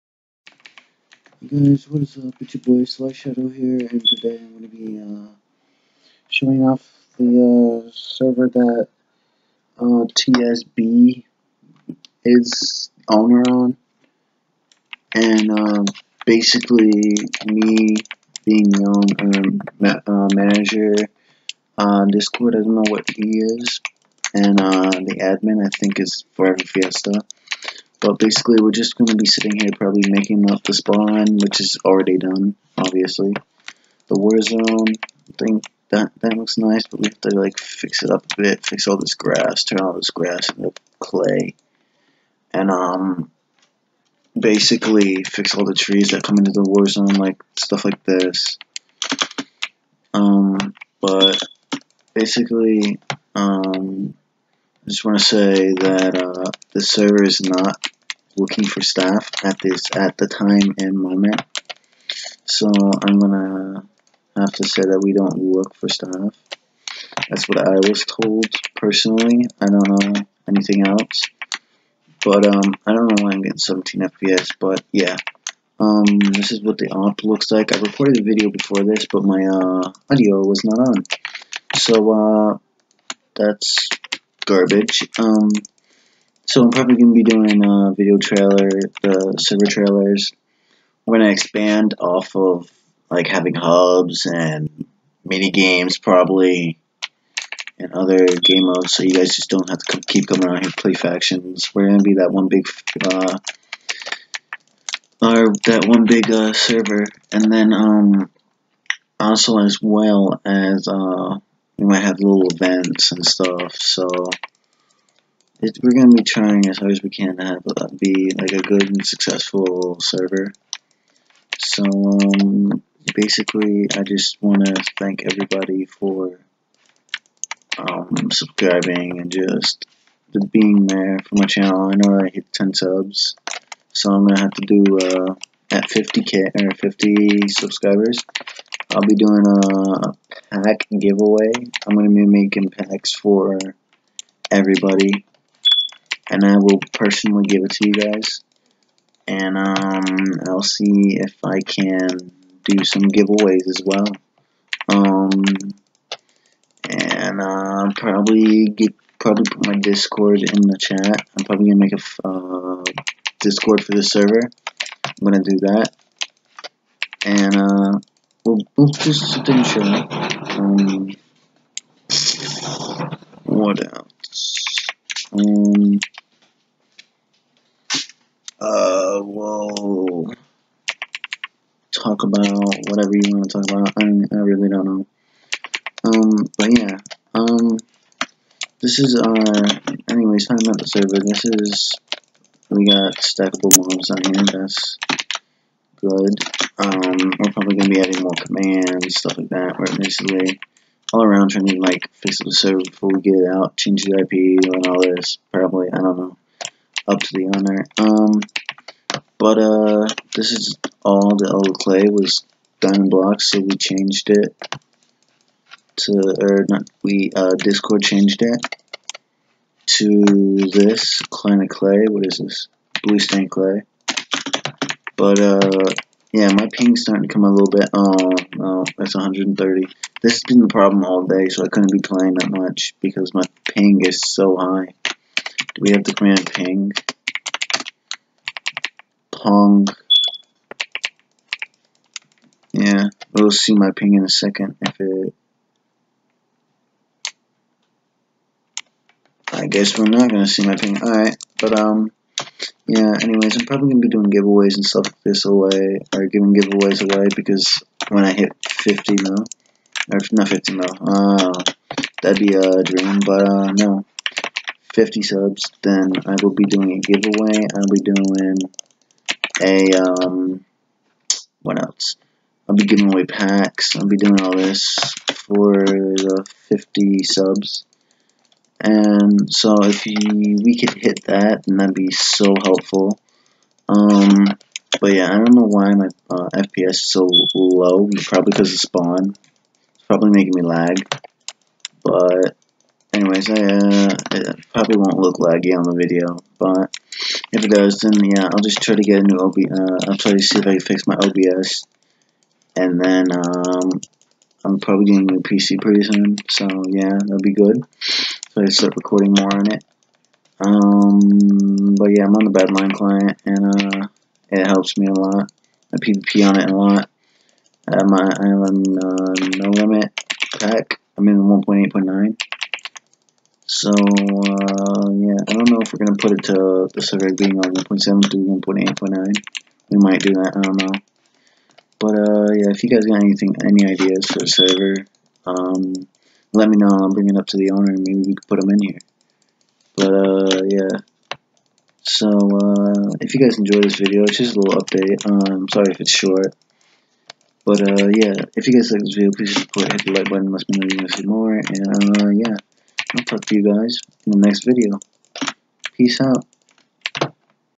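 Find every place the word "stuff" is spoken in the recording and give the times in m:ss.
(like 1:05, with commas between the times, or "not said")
0:47, 1:53, 3:19, 4:14.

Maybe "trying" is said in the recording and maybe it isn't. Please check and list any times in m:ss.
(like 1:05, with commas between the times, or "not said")
1:56, 3:21.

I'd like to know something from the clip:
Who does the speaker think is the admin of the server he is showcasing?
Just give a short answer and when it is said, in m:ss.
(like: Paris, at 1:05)
Forever Fiesta, at 0:26.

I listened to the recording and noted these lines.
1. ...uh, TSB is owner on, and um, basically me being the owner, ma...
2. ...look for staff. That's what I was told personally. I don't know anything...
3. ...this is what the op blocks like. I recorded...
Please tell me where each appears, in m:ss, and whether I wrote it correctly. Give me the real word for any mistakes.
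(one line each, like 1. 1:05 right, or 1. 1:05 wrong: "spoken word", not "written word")
1. 0:09 right
2. 1:05 right
3. 1:16 wrong: "looks", not "blocks".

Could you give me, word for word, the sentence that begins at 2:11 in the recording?
I know I hit 10 subs, so I'm going to have to do uh, at 50k or 50 subscribers.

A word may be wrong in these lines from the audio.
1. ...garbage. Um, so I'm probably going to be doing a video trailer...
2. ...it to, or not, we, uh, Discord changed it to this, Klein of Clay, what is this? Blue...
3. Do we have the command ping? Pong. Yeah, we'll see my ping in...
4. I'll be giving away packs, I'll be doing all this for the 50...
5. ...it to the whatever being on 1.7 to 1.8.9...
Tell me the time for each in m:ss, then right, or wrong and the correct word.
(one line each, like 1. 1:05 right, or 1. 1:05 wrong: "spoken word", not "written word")
1. 1:24 right
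2. 3:34 right
3. 3:55 right
4. 4:32 right
5. 5:26 wrong: "server", not "whatever".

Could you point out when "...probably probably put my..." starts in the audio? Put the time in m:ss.
2:37.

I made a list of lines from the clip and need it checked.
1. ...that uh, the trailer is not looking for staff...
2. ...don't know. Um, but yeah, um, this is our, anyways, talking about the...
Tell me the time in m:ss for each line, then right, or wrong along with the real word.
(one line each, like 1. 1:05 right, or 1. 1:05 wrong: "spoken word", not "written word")
1. 0:55 wrong: "server", not "trailer"
2. 3:04 right.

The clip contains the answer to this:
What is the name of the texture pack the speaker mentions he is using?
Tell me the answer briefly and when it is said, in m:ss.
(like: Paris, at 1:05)
No Limit, at 5:19.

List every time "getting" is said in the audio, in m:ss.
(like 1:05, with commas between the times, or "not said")
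1:13, 5:05.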